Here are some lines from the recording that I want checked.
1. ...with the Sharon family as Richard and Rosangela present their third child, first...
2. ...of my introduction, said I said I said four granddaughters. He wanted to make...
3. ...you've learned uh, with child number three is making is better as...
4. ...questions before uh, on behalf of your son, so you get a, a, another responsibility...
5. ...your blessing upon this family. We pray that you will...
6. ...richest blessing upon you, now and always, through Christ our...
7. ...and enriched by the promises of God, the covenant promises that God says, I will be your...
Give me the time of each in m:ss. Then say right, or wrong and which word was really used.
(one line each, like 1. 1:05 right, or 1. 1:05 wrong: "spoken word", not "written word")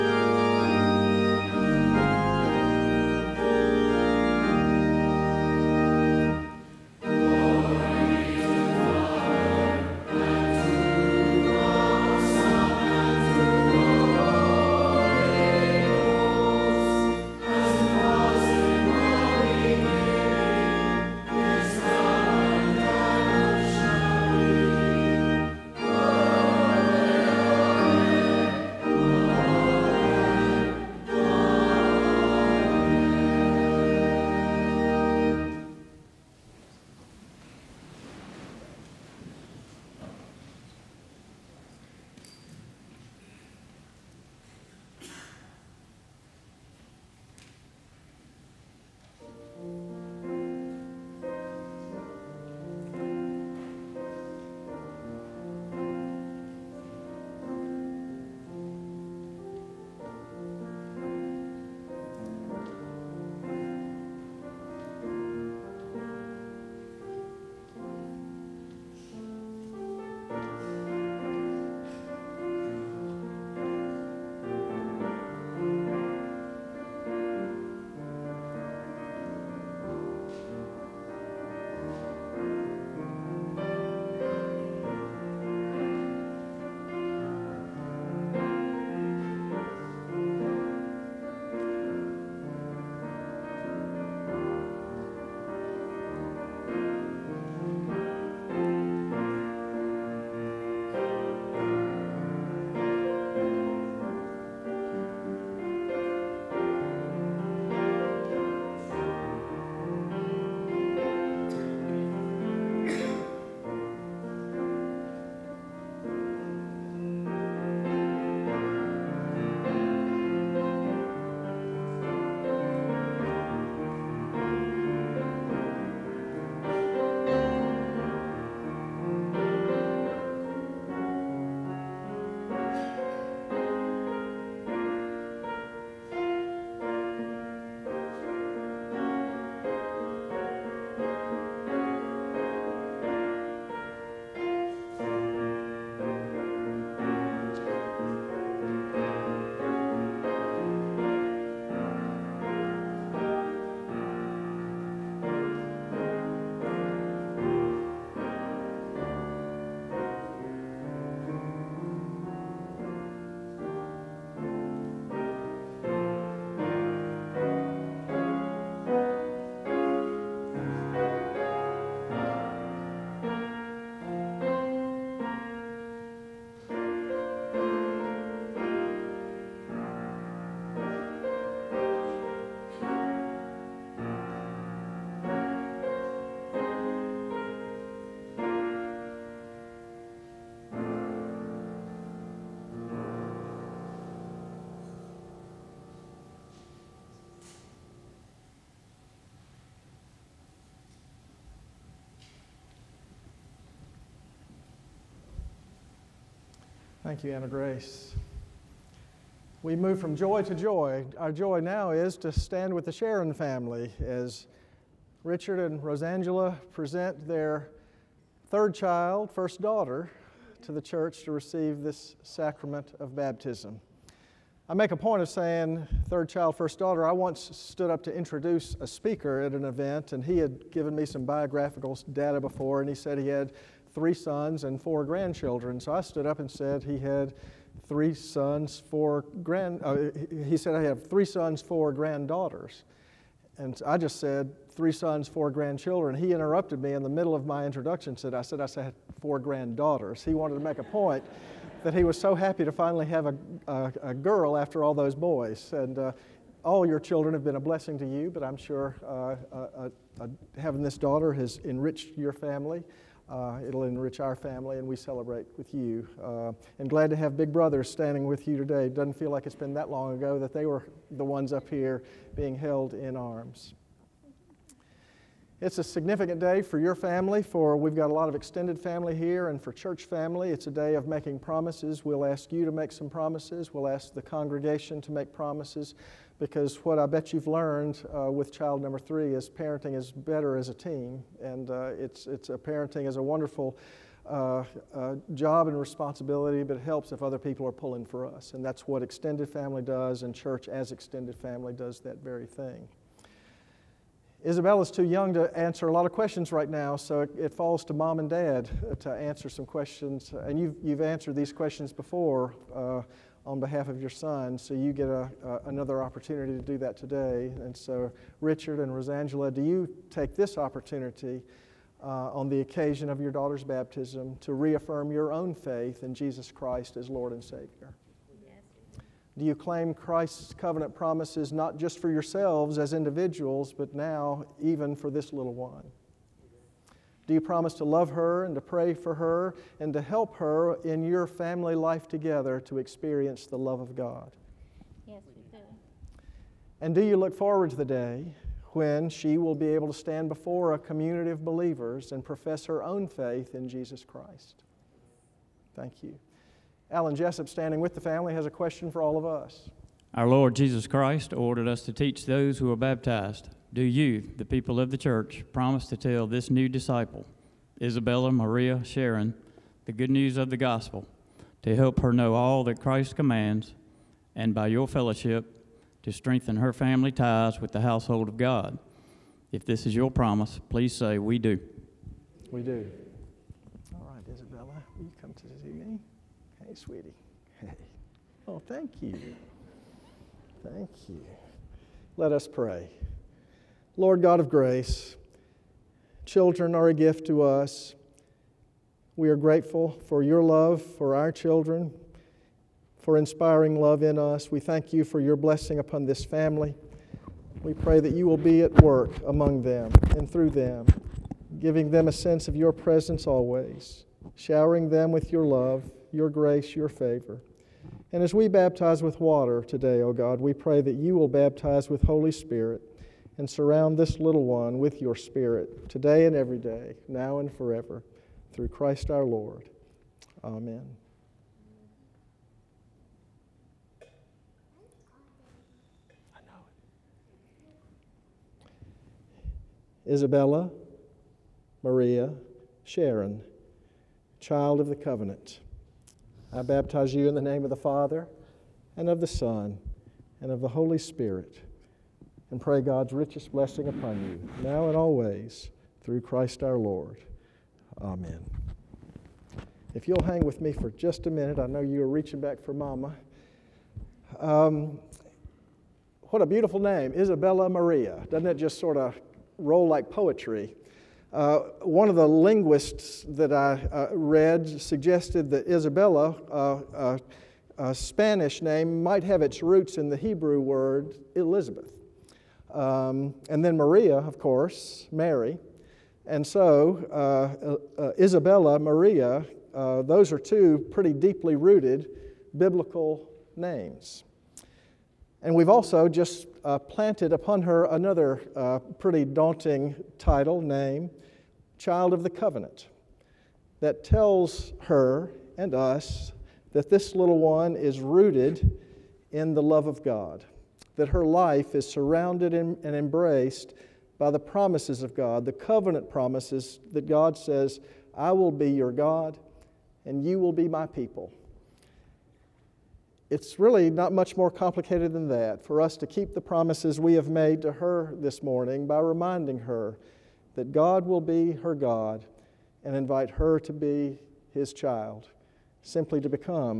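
1. 3:32 right
2. 4:07 right
3. 4:47 wrong: "parenting", not "making"
4. 5:11 wrong: "opportunity", not "responsibility"
5. 6:45 right
6. 7:33 right
7. 8:32 wrong: "embraced", not "enriched".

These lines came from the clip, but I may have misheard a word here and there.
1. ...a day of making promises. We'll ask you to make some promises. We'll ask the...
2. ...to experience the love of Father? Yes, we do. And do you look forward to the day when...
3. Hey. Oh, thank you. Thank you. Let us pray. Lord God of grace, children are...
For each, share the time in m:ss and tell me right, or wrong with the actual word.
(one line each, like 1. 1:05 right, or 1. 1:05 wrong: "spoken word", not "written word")
1. 4:40 right
2. 5:42 wrong: "God", not "Father"
3. 6:27 right.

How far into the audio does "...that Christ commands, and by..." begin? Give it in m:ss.
6:12.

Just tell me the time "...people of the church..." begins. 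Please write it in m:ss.
6:04.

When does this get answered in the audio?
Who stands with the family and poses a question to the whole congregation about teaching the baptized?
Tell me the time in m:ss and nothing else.
5:56.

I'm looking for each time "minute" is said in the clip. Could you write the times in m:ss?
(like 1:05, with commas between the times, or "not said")
7:41.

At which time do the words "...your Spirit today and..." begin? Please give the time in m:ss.
7:04.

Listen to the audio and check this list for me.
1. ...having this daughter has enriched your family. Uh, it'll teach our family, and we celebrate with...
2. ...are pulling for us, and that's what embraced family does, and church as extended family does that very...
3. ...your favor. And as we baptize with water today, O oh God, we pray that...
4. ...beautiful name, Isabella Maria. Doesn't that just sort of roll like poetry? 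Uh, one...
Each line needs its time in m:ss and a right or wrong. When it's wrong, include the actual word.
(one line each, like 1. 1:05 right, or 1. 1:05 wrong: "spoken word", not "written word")
1. 4:20 wrong: "enrich", not "teach"
2. 4:57 wrong: "extended", not "embraced"
3. 6:56 right
4. 7:46 right.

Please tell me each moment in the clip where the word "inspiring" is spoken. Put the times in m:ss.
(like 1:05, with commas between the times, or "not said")
6:43.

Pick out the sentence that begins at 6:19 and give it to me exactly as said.
If this is your promise, please say, We do.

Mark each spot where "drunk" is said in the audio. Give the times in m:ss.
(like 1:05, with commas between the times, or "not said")
not said.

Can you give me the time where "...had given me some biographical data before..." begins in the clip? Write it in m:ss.
3:50.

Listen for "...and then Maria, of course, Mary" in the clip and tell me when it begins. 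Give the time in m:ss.
8:03.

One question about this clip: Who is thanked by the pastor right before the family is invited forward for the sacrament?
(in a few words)
Anna Grace.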